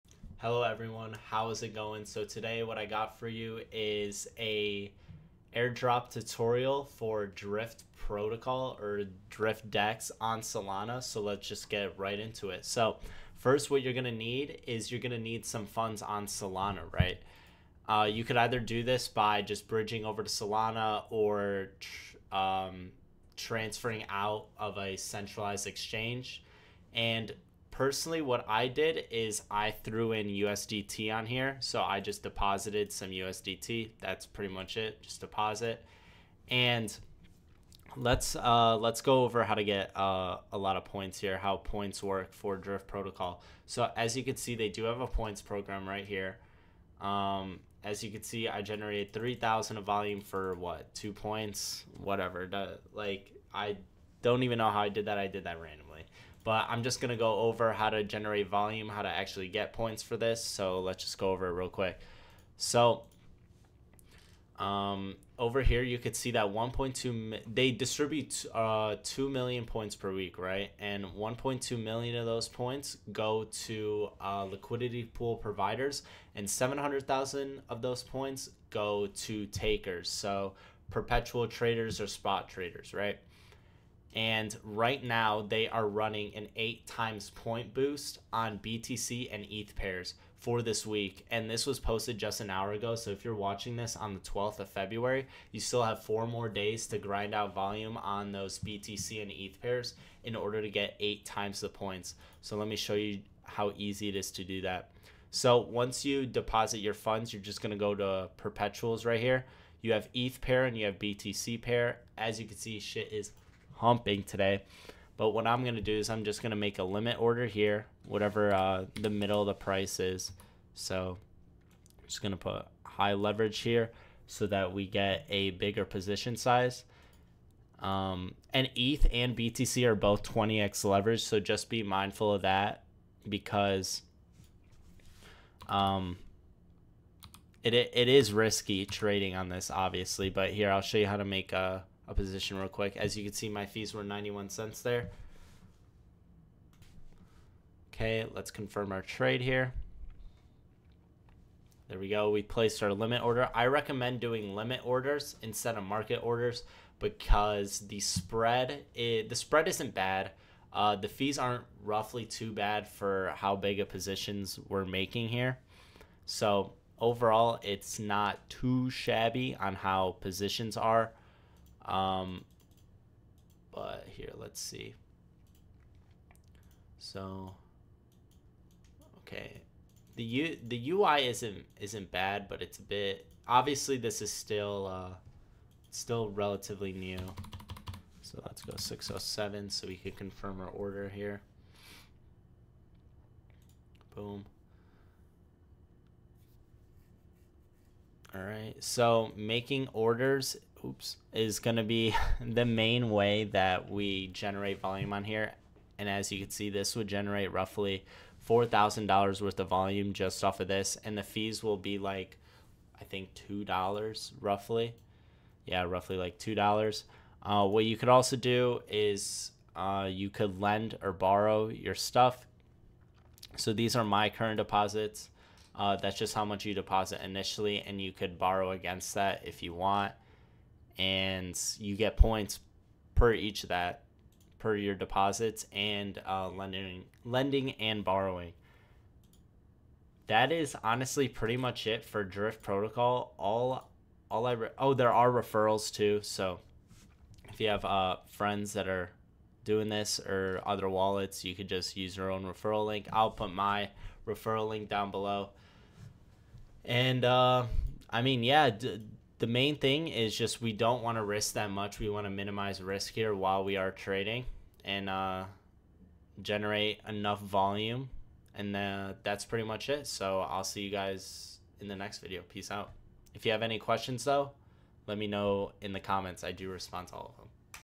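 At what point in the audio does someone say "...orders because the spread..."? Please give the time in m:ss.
2:36.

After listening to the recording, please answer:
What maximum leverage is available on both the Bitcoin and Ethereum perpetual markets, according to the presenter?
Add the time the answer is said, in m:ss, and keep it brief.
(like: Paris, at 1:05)
20x, at 2:10.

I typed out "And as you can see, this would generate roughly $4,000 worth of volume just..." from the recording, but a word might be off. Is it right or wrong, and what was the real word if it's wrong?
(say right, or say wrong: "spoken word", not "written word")
right.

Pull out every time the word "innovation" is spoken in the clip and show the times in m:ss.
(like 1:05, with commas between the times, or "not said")
not said.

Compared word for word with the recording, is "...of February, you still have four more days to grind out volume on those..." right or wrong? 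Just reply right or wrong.
right.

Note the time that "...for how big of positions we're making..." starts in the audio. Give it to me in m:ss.
2:42.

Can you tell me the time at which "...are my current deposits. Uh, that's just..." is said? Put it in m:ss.
3:43.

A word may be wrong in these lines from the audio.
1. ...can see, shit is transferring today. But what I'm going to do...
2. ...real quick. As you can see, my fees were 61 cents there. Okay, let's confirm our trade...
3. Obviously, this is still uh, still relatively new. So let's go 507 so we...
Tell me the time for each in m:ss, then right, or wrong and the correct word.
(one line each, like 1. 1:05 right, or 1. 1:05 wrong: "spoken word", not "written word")
1. 1:52 wrong: "humping", not "transferring"
2. 2:22 wrong: "91", not "61"
3. 3:03 wrong: "607", not "507".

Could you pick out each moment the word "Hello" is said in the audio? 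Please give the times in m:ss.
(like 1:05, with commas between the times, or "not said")
0:00.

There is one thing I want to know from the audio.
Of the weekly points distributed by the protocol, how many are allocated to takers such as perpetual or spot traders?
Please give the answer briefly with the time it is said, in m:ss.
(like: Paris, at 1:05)
700,000, at 1:16.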